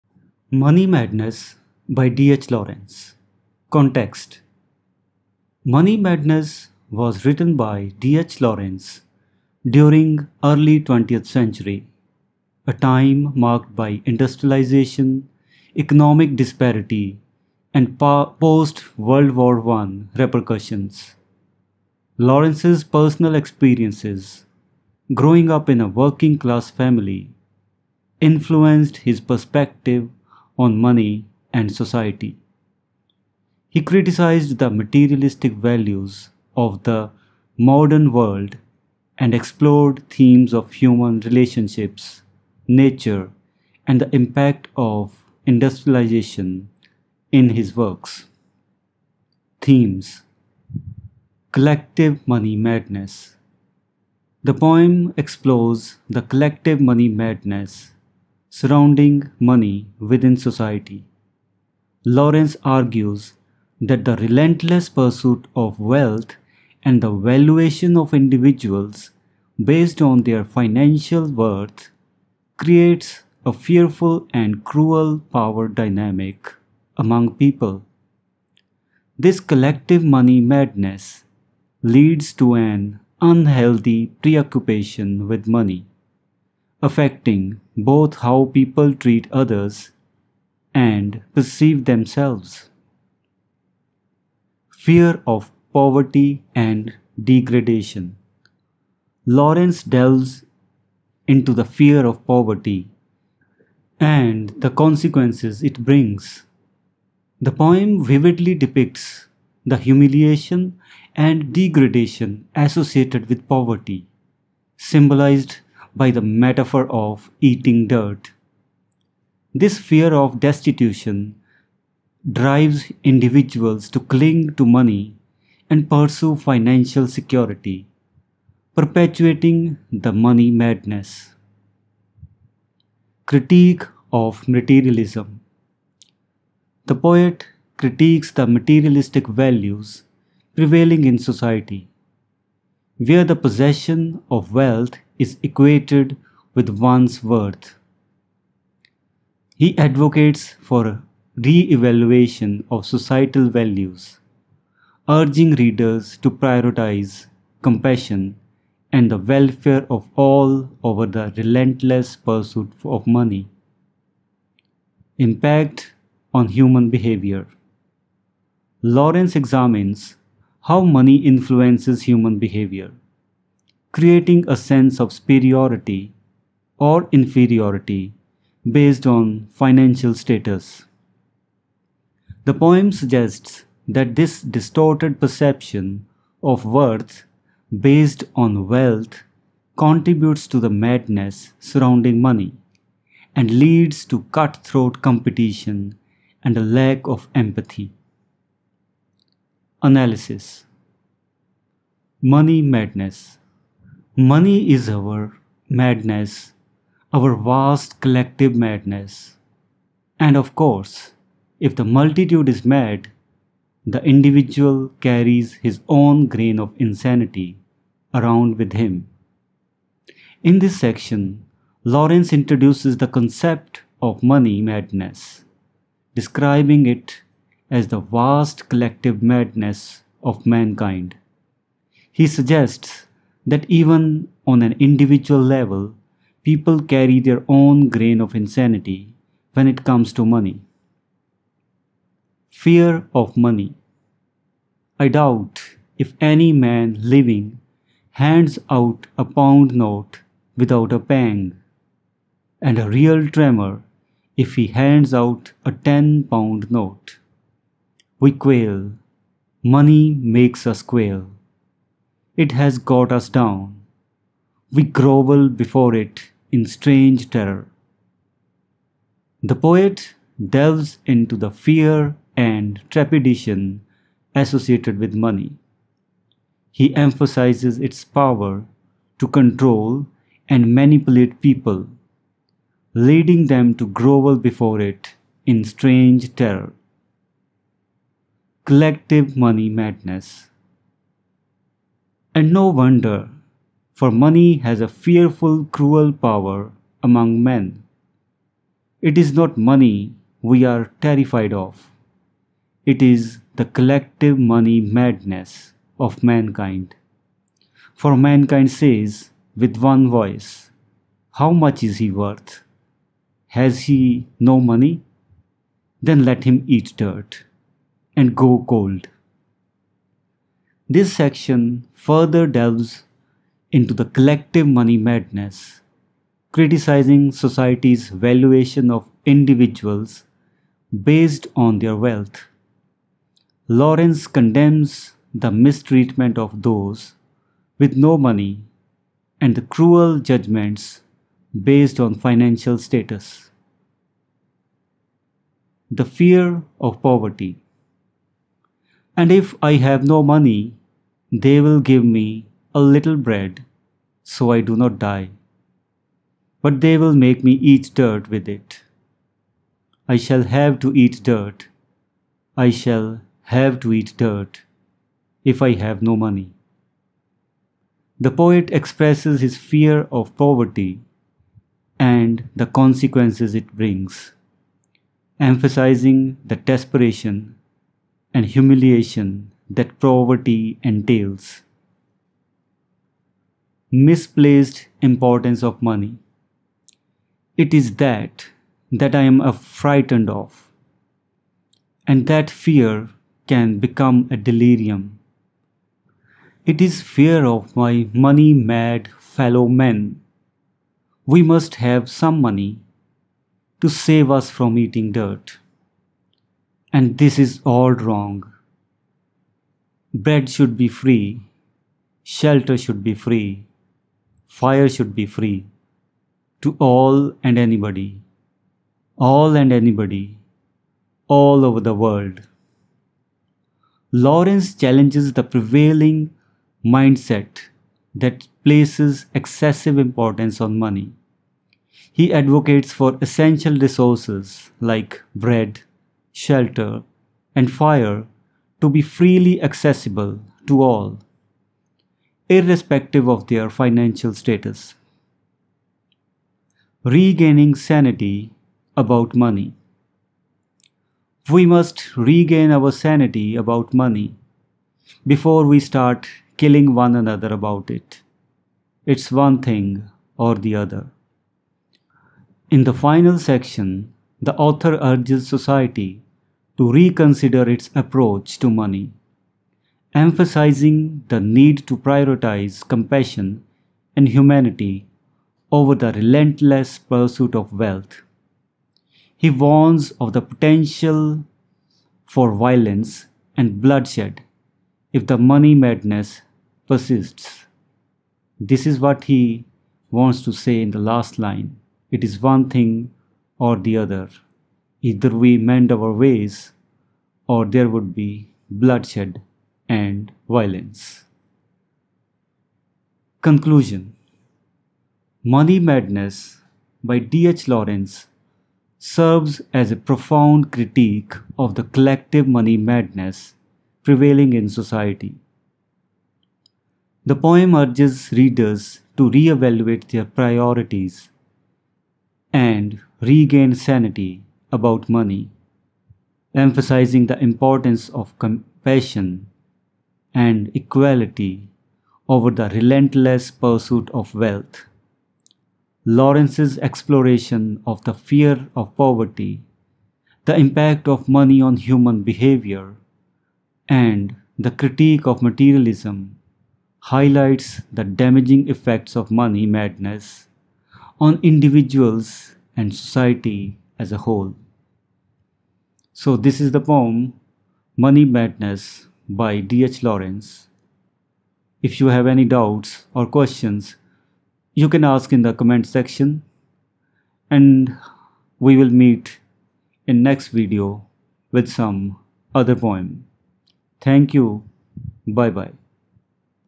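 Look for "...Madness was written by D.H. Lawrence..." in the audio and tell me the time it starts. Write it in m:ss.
0:05.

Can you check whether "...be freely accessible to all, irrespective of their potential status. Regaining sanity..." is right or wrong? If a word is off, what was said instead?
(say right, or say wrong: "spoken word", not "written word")
wrong: "financial", not "potential".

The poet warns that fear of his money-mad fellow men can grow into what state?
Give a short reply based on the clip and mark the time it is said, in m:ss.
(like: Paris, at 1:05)
delirium, at 6:34.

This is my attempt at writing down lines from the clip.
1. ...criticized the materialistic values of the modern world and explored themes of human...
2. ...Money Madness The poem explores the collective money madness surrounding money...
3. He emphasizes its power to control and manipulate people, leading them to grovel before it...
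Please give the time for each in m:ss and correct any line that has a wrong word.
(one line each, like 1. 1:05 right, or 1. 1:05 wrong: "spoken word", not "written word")
1. 0:33 right
2. 0:52 right
3. 4:36 right.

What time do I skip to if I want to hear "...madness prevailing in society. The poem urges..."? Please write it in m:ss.
8:32.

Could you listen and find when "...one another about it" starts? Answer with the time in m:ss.
7:36.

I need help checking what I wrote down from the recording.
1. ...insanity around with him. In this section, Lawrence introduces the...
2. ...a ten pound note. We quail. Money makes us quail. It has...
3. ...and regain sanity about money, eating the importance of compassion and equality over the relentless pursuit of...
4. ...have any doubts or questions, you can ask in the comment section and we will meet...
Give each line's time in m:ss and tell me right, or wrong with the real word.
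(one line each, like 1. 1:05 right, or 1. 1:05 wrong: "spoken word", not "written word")
1. 3:36 right
2. 4:15 right
3. 8:42 wrong: "emphasizing", not "eating"
4. 9:22 right.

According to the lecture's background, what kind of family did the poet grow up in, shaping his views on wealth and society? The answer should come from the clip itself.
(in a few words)
working class family.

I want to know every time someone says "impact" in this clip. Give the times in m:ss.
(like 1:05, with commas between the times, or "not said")
0:44, 2:45, 9:00.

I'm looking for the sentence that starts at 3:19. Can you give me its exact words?
Analysis Money Madness Money is our madness, our vast collective madness.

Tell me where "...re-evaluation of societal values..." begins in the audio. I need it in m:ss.
2:31.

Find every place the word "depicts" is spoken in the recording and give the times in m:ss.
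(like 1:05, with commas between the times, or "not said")
1:48.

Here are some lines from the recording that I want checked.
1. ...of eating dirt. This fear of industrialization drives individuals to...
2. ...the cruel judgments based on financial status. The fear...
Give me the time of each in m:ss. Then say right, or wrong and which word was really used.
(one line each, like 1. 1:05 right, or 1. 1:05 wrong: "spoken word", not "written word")
1. 1:56 wrong: "destitution", not "industrialization"
2. 5:39 right.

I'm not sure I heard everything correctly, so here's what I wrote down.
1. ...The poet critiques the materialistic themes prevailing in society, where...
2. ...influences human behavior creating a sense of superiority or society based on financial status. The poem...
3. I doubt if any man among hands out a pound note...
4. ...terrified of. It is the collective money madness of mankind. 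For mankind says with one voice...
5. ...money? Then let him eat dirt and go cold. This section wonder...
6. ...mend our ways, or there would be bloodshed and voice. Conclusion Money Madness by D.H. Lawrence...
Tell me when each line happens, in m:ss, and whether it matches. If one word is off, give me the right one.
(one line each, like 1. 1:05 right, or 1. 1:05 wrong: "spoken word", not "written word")
1. 2:16 wrong: "values", not "themes"
2. 2:51 wrong: "inferiority", not "society"
3. 4:04 wrong: "living", not "among"
4. 5:01 right
5. 5:14 wrong: "further", not "wonder"
6. 8:15 wrong: "violence", not "voice".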